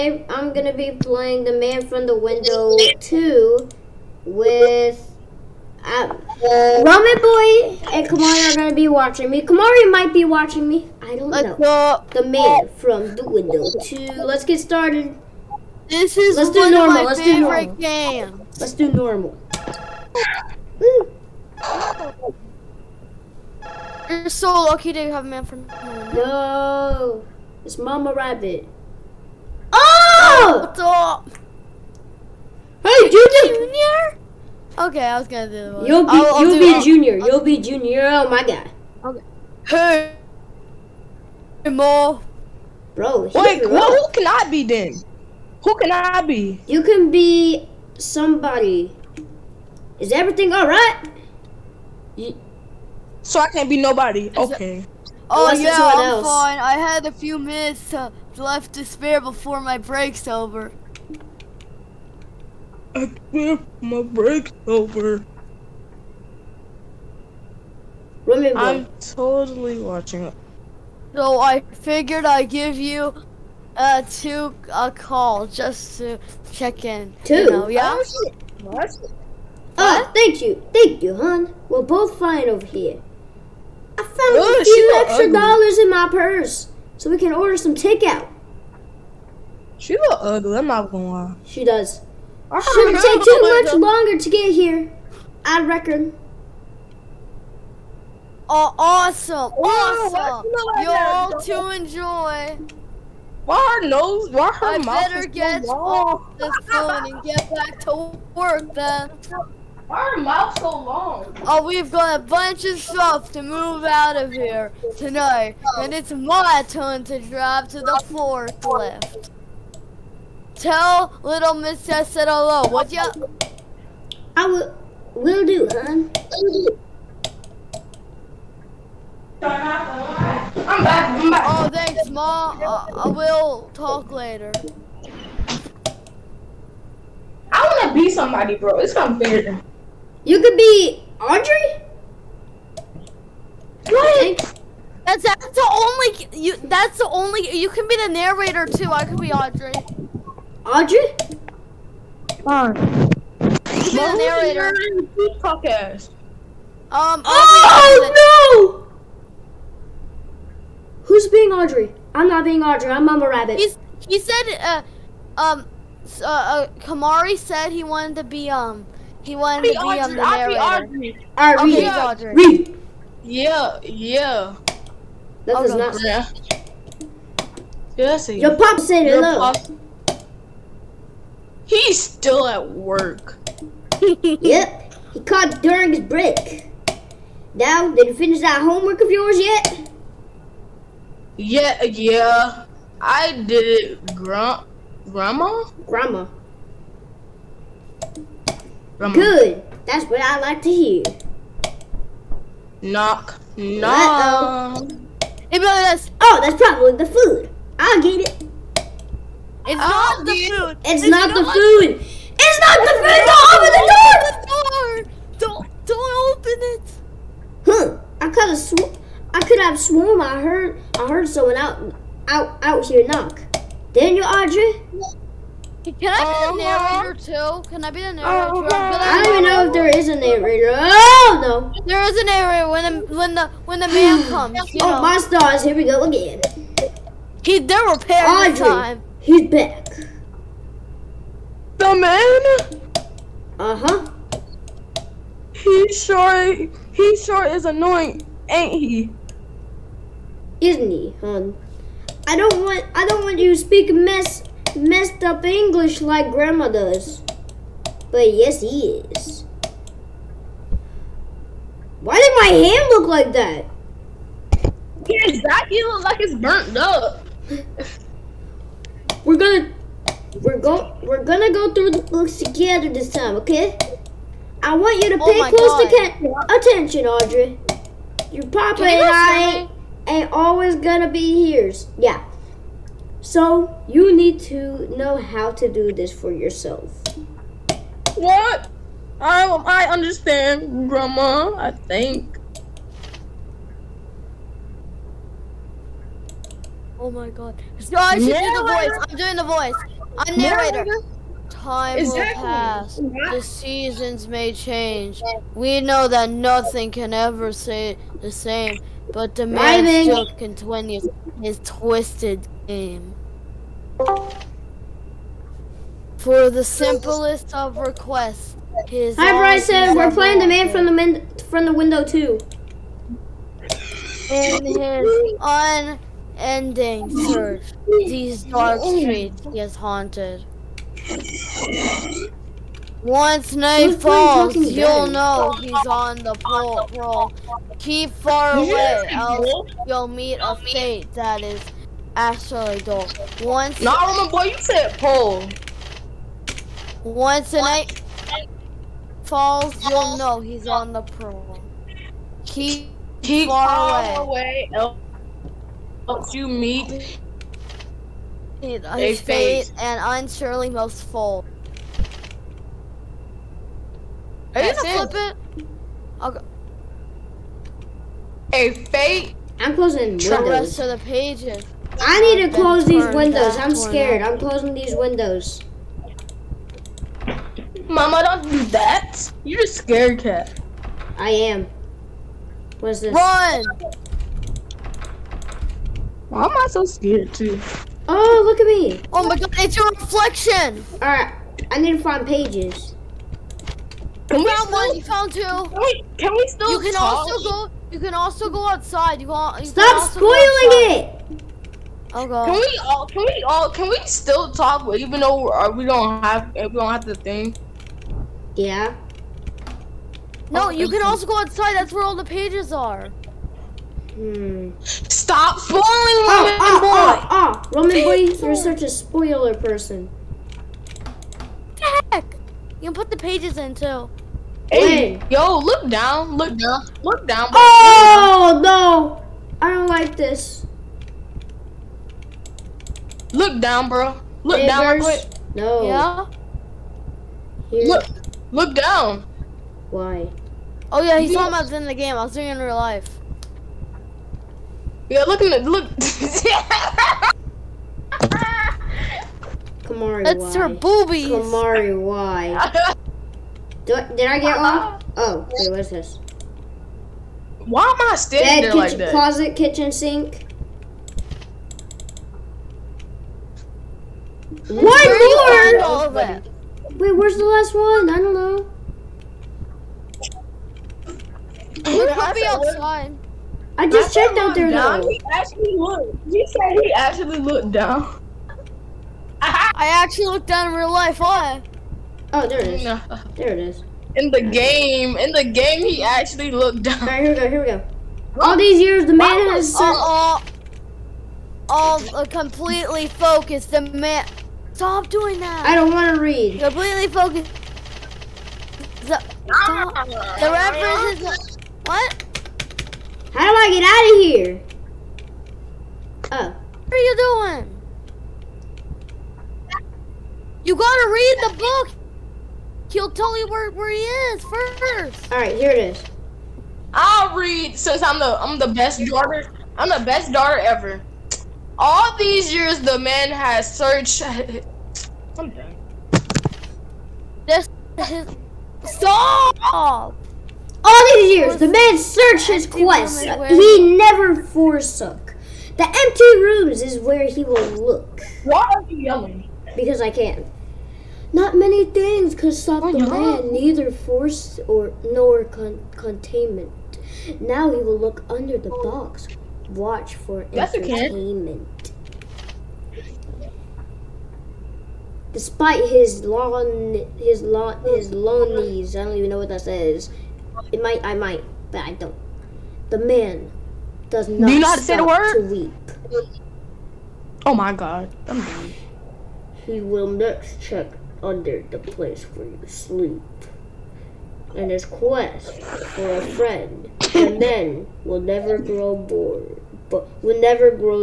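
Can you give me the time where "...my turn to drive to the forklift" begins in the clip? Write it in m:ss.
1:56.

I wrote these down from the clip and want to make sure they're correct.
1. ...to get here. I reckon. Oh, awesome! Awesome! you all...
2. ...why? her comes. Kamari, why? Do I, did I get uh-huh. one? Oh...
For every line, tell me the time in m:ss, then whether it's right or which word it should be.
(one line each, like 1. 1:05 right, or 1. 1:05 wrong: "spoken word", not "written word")
1. 1:34 right
2. 7:30 wrong: "boobies", not "comes".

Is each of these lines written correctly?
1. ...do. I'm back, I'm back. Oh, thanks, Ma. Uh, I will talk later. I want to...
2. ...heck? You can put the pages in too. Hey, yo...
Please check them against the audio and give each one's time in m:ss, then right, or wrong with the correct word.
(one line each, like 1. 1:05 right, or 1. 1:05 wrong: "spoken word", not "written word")
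1. 2:06 right
2. 7:02 right.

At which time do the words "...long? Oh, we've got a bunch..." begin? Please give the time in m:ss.
1:50.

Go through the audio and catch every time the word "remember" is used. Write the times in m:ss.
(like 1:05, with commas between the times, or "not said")
1:08, 5:44.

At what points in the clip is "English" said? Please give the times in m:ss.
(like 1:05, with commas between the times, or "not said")
4:15.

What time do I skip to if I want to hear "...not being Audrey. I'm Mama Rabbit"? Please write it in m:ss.
2:42.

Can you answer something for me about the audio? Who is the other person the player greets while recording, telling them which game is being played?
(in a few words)
Bryson.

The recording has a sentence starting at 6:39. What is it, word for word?
You, want, you Stop spoiling outside.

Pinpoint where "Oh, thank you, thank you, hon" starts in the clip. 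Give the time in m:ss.
1:19.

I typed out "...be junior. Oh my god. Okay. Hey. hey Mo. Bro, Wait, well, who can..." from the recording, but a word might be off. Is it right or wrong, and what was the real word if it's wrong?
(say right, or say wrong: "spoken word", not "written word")
right.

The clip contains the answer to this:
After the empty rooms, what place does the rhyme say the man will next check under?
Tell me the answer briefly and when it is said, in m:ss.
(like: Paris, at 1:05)
Where you sleep, at 9:31.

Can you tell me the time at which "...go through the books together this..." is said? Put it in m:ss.
4:31.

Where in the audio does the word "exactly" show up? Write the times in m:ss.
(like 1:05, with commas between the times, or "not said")
4:25, 5:01.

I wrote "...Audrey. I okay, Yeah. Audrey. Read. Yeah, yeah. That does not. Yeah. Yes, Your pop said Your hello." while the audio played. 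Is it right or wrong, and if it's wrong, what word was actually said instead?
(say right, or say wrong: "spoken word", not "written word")
right.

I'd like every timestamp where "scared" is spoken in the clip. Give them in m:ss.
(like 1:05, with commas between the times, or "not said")
6:13, 6:19, 6:26.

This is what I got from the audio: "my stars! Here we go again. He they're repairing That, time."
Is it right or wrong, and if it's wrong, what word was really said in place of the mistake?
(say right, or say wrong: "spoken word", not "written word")
wrong: "Audrey", not "That".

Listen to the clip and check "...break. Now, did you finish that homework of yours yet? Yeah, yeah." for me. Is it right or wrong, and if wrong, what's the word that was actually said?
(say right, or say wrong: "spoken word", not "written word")
right.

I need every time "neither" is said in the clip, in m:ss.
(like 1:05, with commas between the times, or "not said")
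9:03.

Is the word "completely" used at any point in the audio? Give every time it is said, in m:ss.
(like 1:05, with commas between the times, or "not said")
8:12, 8:16.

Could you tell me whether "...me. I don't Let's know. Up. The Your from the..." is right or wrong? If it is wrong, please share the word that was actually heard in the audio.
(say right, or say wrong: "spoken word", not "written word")
wrong: "Man", not "Your".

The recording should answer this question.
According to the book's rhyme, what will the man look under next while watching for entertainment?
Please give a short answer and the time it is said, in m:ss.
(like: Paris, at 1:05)
The box, at 9:08.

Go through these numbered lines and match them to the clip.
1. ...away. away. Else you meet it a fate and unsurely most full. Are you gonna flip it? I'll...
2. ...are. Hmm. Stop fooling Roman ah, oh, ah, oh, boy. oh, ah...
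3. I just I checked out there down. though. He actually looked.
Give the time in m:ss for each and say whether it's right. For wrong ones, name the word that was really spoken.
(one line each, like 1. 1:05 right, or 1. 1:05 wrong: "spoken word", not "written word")
1. 5:54 right
2. 6:52 right
3. 7:53 right.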